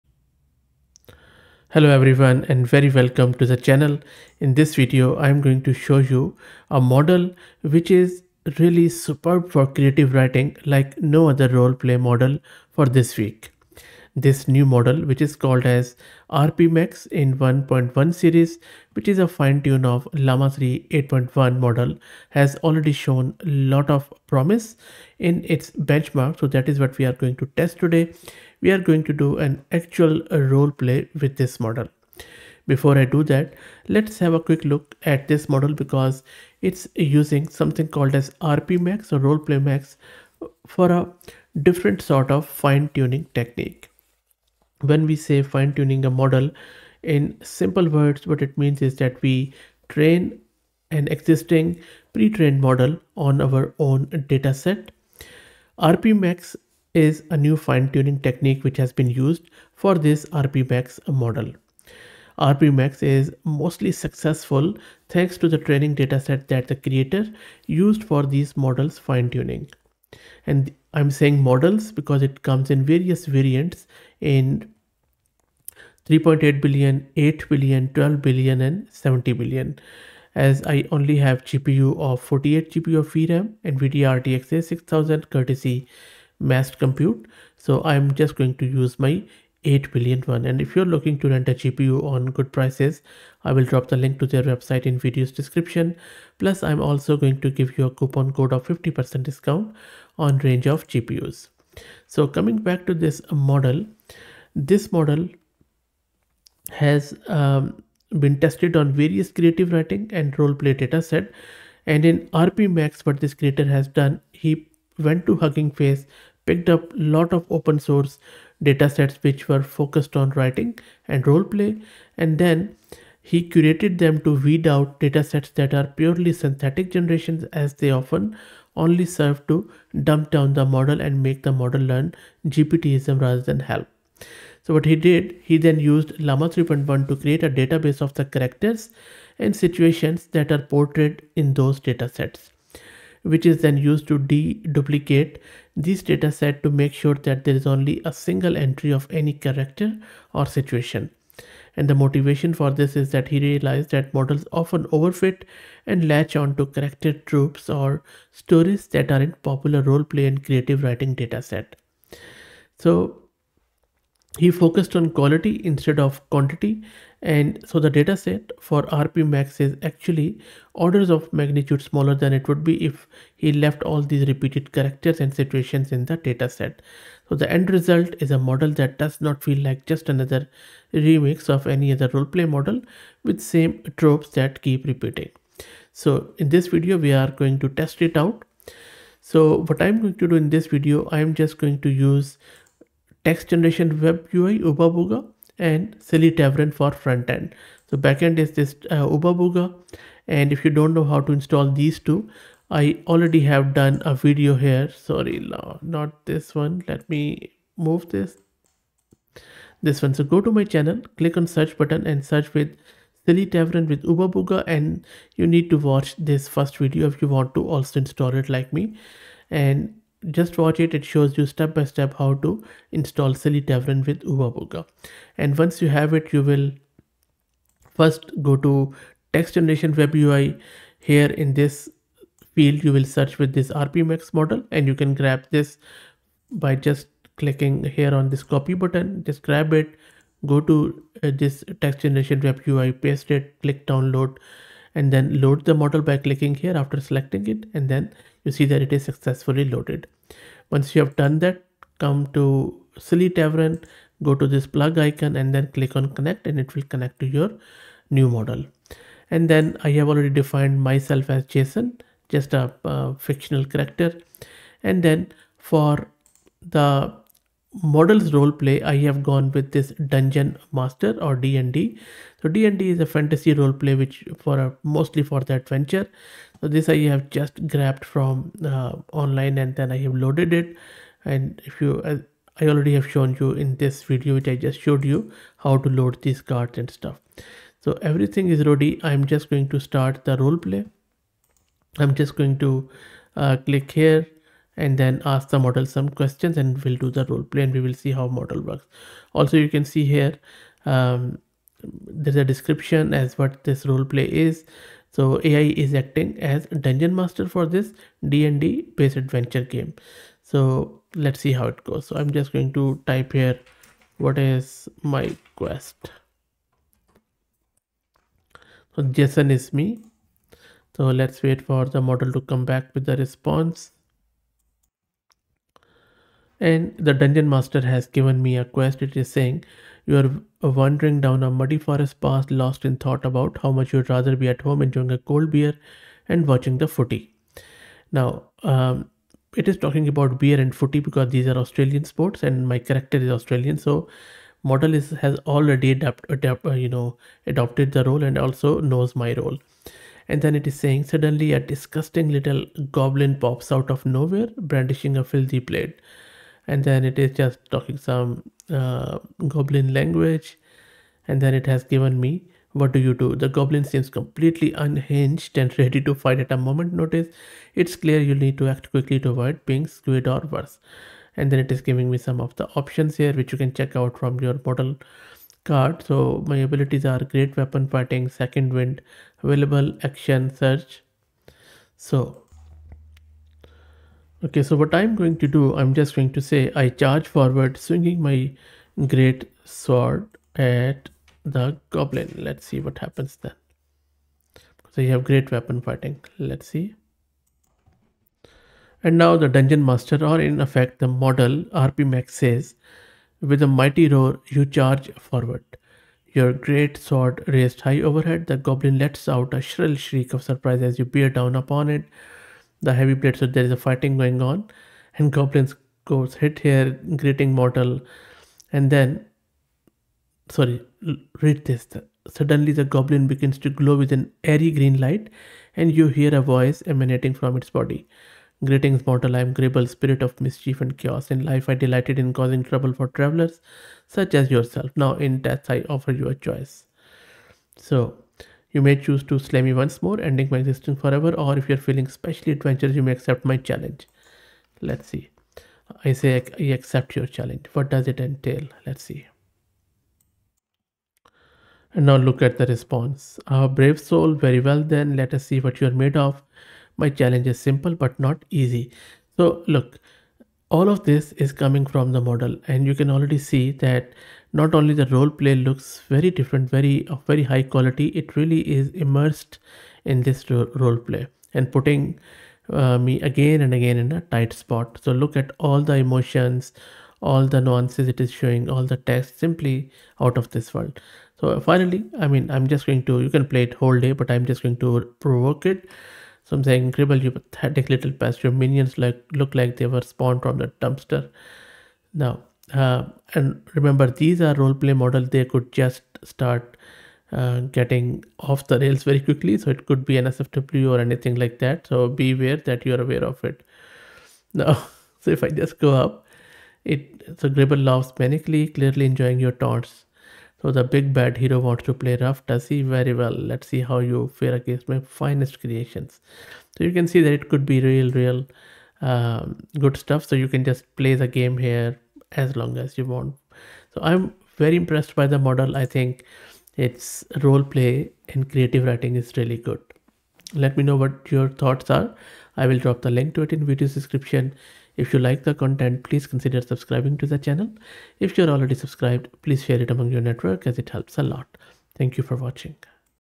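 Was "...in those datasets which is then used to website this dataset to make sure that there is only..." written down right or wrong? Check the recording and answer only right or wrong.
wrong.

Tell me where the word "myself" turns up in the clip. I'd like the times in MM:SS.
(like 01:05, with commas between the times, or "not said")
04:20.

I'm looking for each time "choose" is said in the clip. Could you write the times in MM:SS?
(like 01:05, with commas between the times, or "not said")
07:18.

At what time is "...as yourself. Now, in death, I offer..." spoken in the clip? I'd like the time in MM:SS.
07:14.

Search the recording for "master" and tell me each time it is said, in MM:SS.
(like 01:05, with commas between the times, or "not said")
04:30, 05:07, 05:27, 06:39.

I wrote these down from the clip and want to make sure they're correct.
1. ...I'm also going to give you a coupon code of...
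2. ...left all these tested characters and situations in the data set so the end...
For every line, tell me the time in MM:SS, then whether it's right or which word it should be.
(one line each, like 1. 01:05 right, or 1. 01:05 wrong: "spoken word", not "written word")
1. 01:36 right
2. 02:53 wrong: "repeated", not "tested".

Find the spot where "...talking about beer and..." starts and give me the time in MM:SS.
05:39.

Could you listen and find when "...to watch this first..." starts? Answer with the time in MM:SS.
03:35.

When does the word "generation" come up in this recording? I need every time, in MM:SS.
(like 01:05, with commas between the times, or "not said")
02:06, 03:13, 03:49, 04:02.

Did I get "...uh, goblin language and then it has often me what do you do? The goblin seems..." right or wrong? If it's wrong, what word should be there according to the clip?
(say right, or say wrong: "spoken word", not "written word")
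wrong: "given", not "often".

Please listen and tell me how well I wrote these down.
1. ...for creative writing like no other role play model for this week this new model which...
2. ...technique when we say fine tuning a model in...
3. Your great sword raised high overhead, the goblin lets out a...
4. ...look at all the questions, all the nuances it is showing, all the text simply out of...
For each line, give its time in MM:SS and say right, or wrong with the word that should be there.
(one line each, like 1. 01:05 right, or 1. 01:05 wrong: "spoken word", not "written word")
1. 00:09 right
2. 00:43 right
3. 06:46 right
4. 07:55 wrong: "emotions", not "questions".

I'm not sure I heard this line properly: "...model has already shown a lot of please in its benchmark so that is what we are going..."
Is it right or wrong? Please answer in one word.
wrong.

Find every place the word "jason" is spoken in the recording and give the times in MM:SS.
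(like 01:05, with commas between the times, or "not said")
04:21, 05:19.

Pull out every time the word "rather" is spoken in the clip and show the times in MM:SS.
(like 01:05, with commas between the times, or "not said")
02:13, 05:34.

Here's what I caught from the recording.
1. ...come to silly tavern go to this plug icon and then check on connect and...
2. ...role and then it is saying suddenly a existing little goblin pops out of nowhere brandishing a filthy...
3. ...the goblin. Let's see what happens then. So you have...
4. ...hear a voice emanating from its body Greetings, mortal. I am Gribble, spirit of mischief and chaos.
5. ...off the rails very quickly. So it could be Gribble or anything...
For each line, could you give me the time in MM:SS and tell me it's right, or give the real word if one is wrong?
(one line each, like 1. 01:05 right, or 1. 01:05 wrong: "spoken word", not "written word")
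1. 04:11 wrong: "click", not "check"
2. 05:49 wrong: "disgusting", not "existing"
3. 06:31 right
4. 07:06 right
5. 08:18 wrong: "NSFW", not "Gribble".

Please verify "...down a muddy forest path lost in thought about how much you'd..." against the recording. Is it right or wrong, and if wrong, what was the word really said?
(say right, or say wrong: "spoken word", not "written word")
right.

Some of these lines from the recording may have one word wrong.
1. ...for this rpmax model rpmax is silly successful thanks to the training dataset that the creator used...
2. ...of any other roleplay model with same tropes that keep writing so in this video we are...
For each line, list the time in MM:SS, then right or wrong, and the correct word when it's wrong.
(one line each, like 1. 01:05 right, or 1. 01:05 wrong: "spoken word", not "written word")
1. 00:59 wrong: "mostly", not "silly"
2. 03:01 wrong: "repeating", not "writing".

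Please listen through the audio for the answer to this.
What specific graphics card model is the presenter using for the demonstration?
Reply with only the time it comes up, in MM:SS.
01:23.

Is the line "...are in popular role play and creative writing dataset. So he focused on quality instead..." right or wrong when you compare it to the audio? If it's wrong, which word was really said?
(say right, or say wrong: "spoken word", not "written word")
right.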